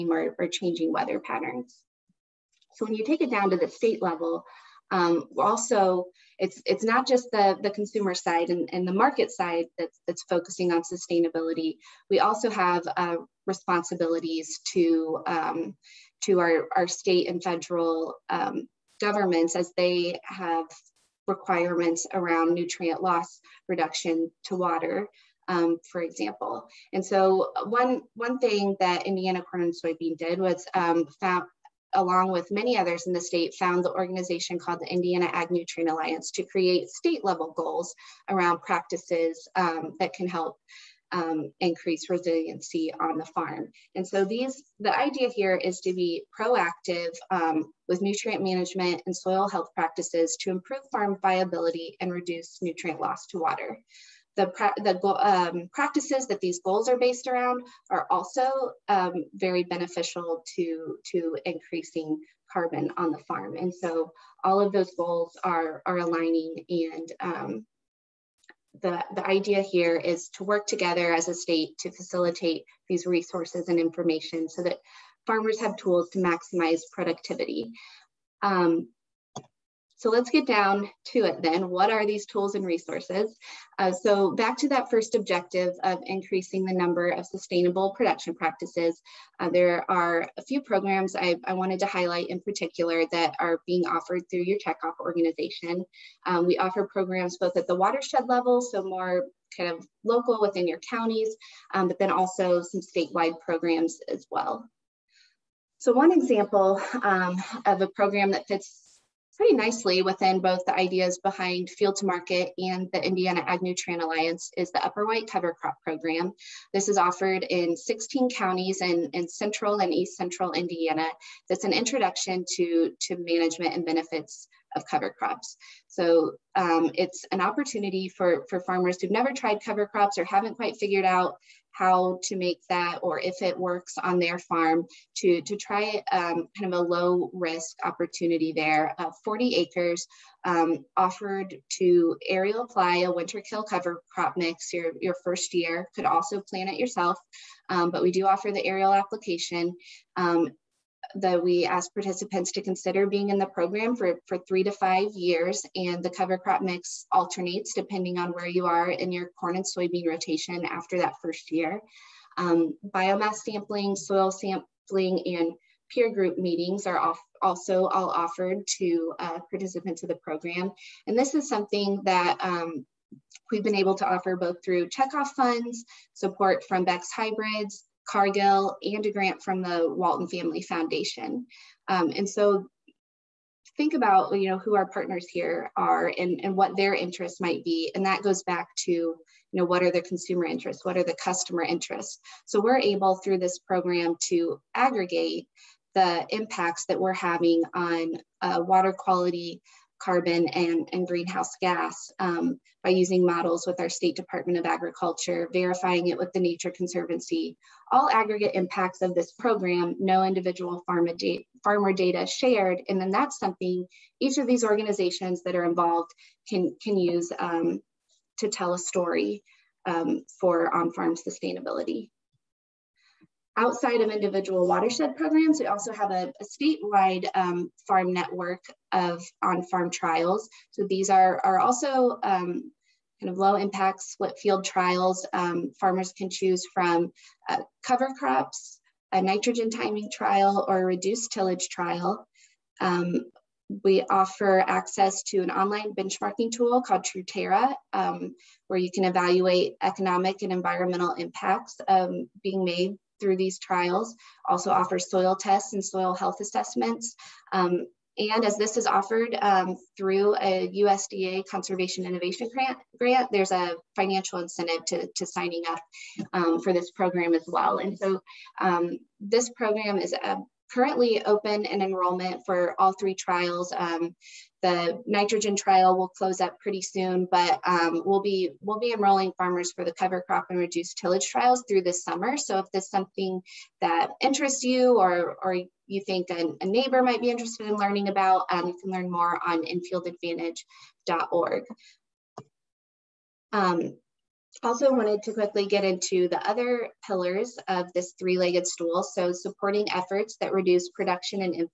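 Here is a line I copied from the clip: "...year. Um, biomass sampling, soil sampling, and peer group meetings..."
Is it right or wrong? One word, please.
right.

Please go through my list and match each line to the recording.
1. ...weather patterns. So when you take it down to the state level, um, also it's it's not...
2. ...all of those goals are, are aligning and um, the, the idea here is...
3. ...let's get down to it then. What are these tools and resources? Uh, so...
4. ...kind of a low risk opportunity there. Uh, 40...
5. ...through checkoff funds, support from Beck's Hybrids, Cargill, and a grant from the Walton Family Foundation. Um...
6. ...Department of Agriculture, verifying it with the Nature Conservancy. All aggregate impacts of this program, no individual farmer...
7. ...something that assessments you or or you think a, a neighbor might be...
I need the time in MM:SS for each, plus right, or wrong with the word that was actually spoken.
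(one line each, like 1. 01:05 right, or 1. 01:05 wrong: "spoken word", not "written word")
1. 00:00 right
2. 01:04 right
3. 01:20 right
4. 02:16 right
5. 02:54 right
6. 03:24 right
7. 04:42 wrong: "interests", not "assessments".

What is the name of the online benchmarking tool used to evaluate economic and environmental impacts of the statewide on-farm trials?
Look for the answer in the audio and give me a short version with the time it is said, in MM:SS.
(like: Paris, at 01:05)
Truterra, at 04:07.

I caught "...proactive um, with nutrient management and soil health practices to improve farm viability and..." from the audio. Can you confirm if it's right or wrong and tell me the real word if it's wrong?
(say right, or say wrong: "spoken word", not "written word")
right.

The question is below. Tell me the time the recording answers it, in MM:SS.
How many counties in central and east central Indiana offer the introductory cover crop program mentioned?
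01:57.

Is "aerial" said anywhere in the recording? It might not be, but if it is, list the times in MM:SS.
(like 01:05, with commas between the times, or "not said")
02:22, 02:28.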